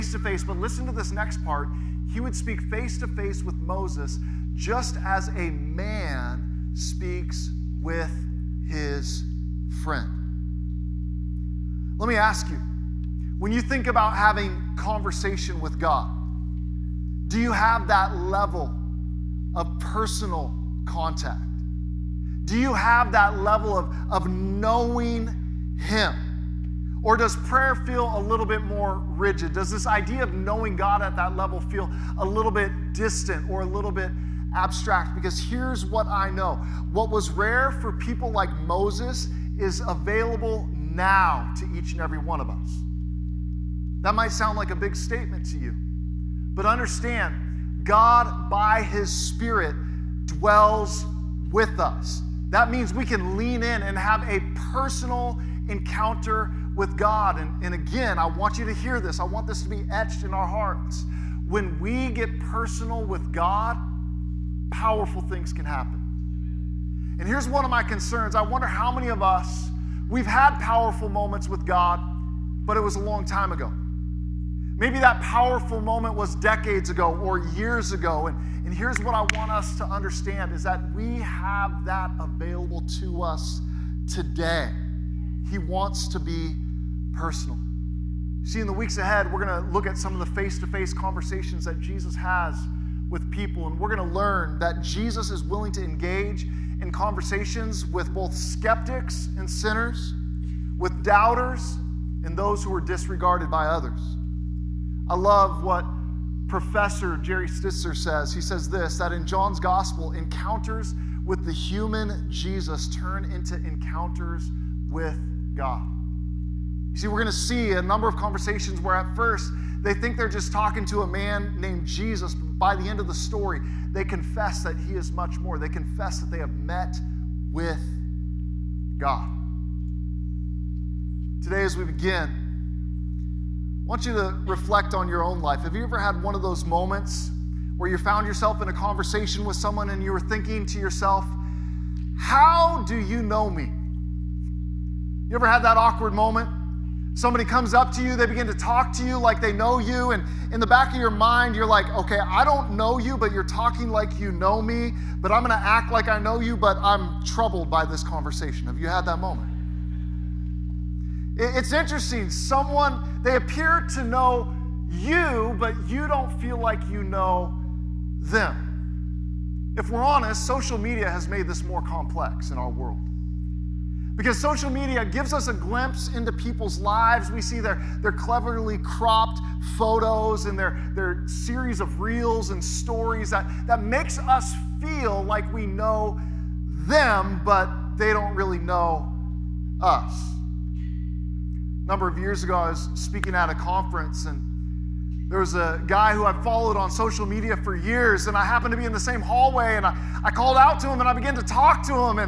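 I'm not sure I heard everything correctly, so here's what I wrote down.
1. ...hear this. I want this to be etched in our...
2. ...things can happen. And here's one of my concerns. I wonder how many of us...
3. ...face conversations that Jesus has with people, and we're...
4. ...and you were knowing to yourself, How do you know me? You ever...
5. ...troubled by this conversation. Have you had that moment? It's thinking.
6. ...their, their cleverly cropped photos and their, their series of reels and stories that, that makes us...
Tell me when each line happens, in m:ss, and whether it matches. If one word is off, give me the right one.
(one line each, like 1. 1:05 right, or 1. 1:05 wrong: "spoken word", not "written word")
1. 0:58 right
2. 1:05 right
3. 1:30 right
4. 2:19 wrong: "thinking", not "knowing"
5. 2:37 wrong: "interesting", not "thinking"
6. 2:57 right.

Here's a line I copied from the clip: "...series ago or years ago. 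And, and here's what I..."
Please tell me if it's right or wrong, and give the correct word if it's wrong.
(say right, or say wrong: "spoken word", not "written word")
wrong: "decades", not "series".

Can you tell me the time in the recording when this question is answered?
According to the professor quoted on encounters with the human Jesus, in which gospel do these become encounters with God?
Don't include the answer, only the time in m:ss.
1:49.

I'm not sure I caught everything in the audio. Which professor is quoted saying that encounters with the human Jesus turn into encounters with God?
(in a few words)
Jerry Stitzer.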